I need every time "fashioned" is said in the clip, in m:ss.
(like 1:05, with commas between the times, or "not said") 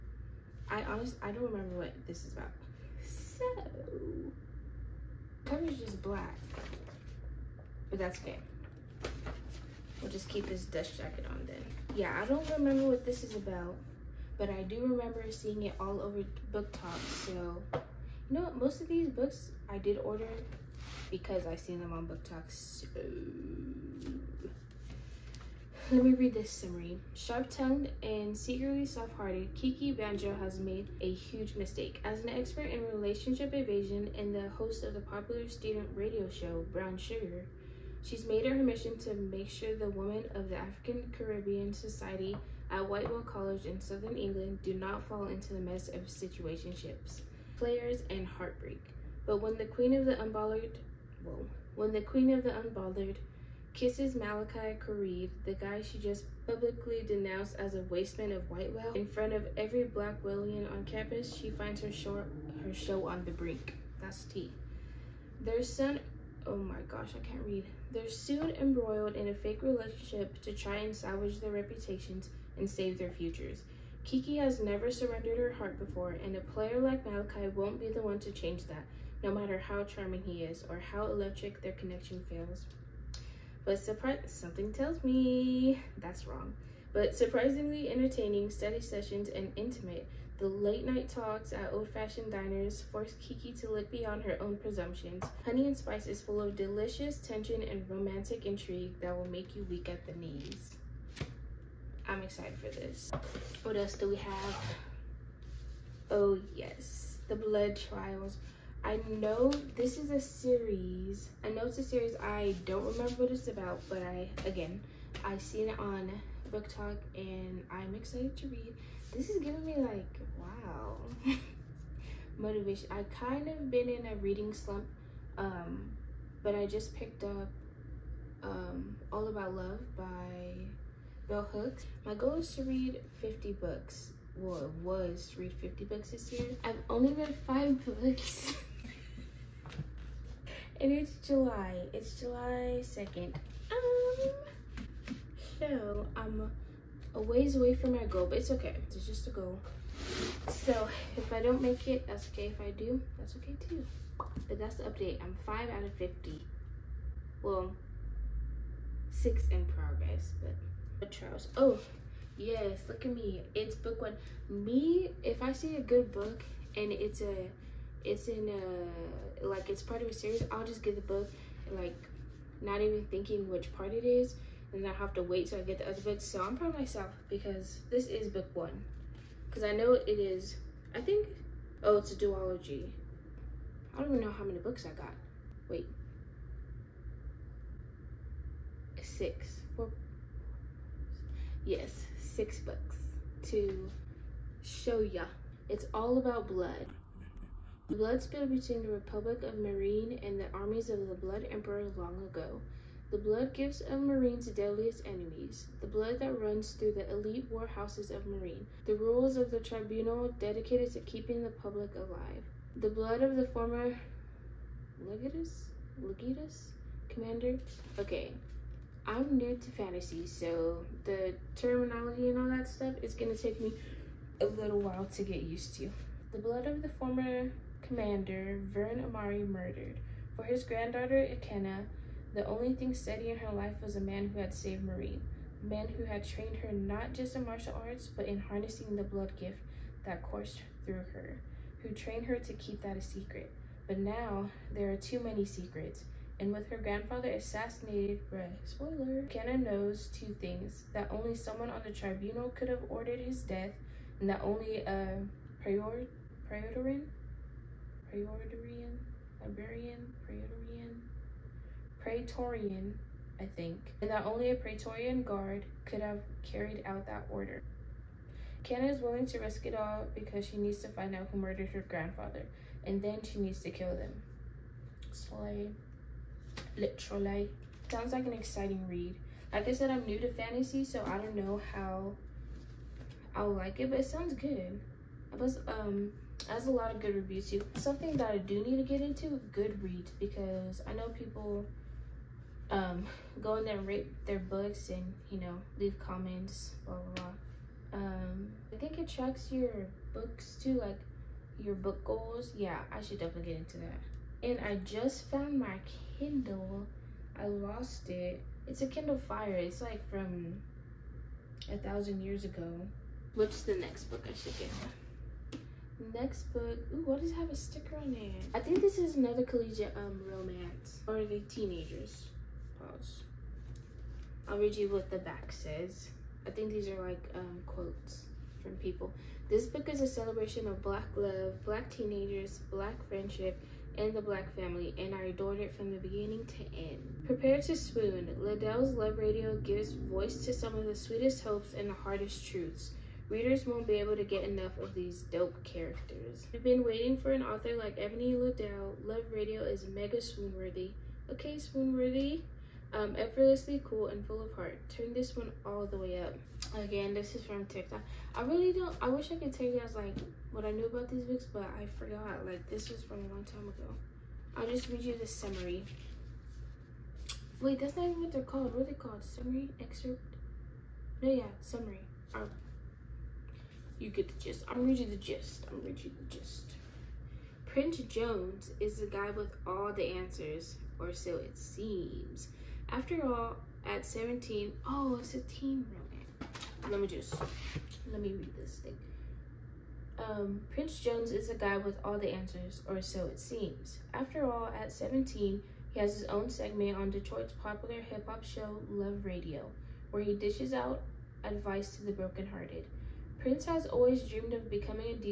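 1:31.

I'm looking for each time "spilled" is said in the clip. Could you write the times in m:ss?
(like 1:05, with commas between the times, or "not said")
3:18.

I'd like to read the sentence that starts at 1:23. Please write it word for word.
But surprise, something tells me that's wrong.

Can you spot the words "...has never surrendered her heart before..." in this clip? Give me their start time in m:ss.
1:14.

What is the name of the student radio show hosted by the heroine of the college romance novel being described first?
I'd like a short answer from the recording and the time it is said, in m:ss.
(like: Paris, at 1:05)
Brown Sugar, at 0:36.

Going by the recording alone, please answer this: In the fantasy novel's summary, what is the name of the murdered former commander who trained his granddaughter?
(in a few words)
Vern Amari.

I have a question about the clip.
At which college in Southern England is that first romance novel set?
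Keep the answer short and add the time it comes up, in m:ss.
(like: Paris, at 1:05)
Whitewell College, at 0:42.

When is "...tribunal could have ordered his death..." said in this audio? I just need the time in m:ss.
4:11.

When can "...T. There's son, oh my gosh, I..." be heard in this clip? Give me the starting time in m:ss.
1:04.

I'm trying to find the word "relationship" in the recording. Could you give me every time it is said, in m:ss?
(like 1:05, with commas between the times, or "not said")
0:32, 1:09.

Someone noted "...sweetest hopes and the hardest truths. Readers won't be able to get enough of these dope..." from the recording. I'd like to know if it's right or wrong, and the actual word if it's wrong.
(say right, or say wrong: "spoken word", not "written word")
right.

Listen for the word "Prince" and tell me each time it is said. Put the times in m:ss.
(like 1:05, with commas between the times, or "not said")
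6:17, 6:30, 6:43.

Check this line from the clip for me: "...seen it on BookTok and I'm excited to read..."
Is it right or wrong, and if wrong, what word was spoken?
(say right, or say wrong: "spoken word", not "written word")
right.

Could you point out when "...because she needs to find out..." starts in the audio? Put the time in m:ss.
4:30.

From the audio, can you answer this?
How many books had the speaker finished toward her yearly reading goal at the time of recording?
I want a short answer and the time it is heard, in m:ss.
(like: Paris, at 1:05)
5, at 2:17.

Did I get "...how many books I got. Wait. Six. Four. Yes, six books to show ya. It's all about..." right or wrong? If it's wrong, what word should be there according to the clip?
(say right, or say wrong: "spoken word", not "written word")
right.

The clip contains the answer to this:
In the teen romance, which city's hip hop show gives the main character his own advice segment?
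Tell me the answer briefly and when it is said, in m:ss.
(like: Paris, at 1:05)
Detroit, at 6:37.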